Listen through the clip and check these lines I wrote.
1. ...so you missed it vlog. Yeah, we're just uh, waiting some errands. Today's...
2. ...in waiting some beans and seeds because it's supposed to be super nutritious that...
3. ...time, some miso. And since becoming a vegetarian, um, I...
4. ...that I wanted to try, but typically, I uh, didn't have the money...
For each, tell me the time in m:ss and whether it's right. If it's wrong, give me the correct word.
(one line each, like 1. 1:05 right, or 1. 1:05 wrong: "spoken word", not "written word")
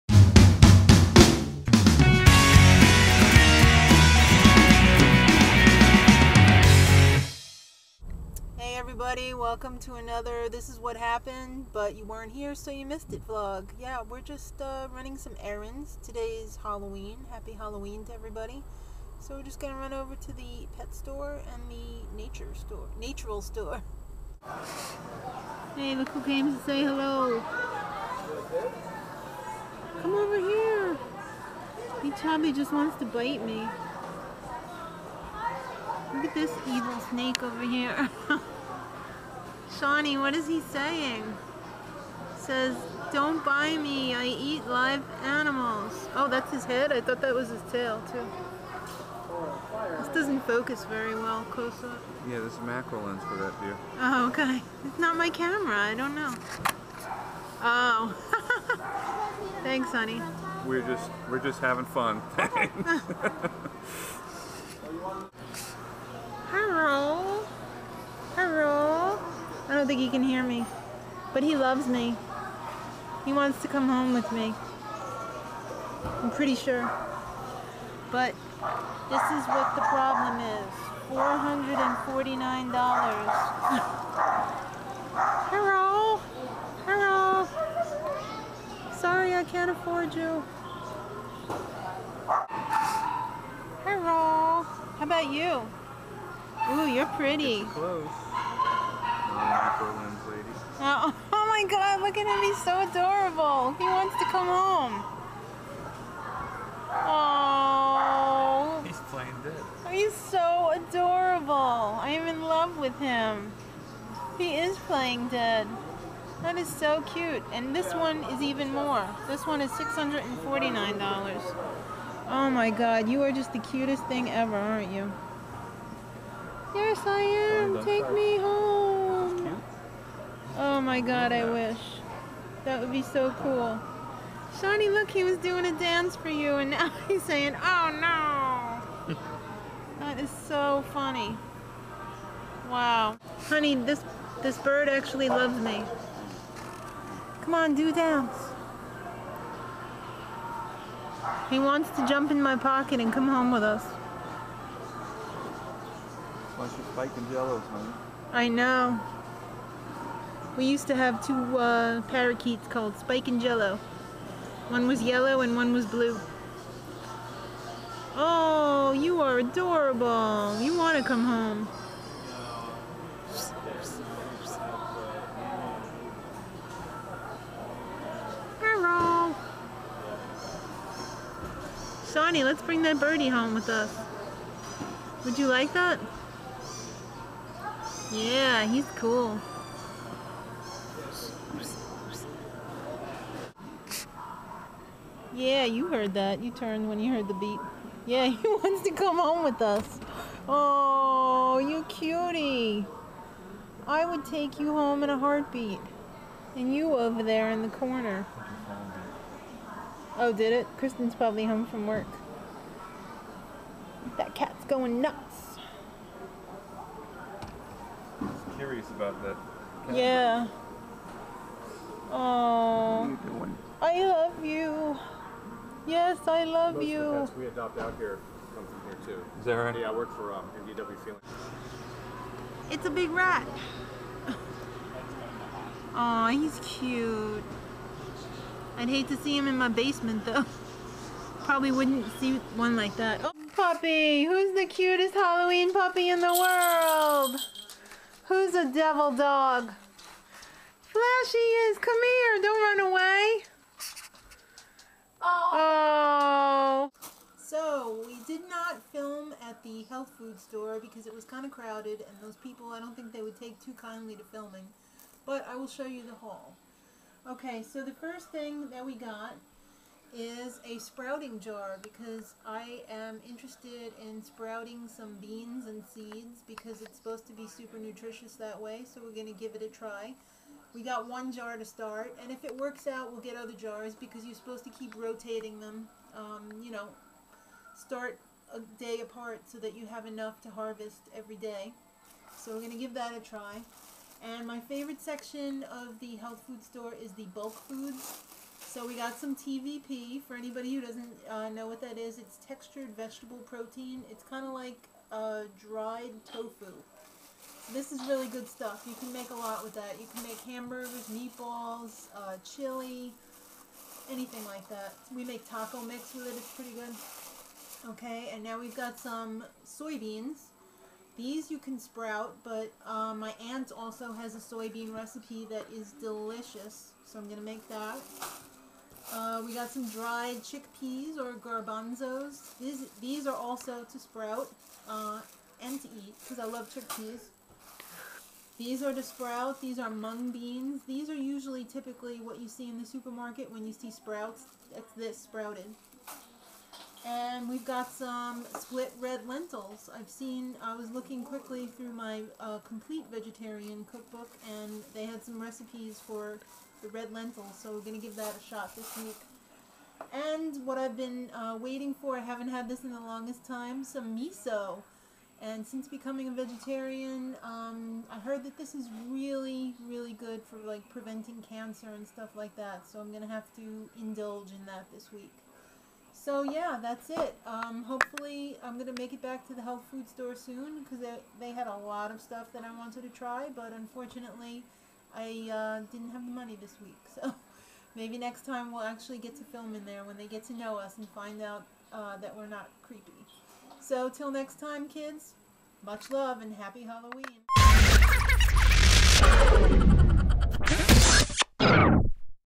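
1. 0:12 wrong: "running", not "waiting"
2. 4:34 wrong: "sprouting", not "waiting"
3. 6:03 right
4. 6:22 wrong: "unfortunately", not "typically".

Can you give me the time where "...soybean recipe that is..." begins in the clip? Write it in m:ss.
5:24.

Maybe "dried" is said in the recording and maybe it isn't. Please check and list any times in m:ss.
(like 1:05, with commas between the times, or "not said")
5:05, 5:29.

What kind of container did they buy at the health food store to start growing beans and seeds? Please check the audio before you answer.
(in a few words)
Sprouting jar.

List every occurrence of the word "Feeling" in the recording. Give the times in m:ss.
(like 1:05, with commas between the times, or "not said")
3:51.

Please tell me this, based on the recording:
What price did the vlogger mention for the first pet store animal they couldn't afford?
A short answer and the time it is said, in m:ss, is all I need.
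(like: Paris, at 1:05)
$449, at 1:21.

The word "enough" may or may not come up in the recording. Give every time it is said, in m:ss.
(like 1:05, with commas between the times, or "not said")
4:50.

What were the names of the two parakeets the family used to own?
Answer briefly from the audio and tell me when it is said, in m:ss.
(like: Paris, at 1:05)
Spike and Jello, at 2:42.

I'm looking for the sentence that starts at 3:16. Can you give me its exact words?
You turned when you heard the beat.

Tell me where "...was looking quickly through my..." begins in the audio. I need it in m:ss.
5:50.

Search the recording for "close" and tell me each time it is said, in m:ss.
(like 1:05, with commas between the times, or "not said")
0:51, 1:37.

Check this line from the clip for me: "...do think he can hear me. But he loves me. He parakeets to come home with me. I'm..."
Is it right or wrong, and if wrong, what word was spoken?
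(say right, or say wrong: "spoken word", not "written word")
wrong: "wants", not "parakeets".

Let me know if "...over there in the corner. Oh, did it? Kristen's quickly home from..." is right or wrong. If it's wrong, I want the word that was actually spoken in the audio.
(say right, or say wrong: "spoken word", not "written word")
wrong: "probably", not "quickly".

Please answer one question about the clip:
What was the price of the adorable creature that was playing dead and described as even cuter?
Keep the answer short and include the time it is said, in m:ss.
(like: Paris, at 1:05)
$649, at 1:59.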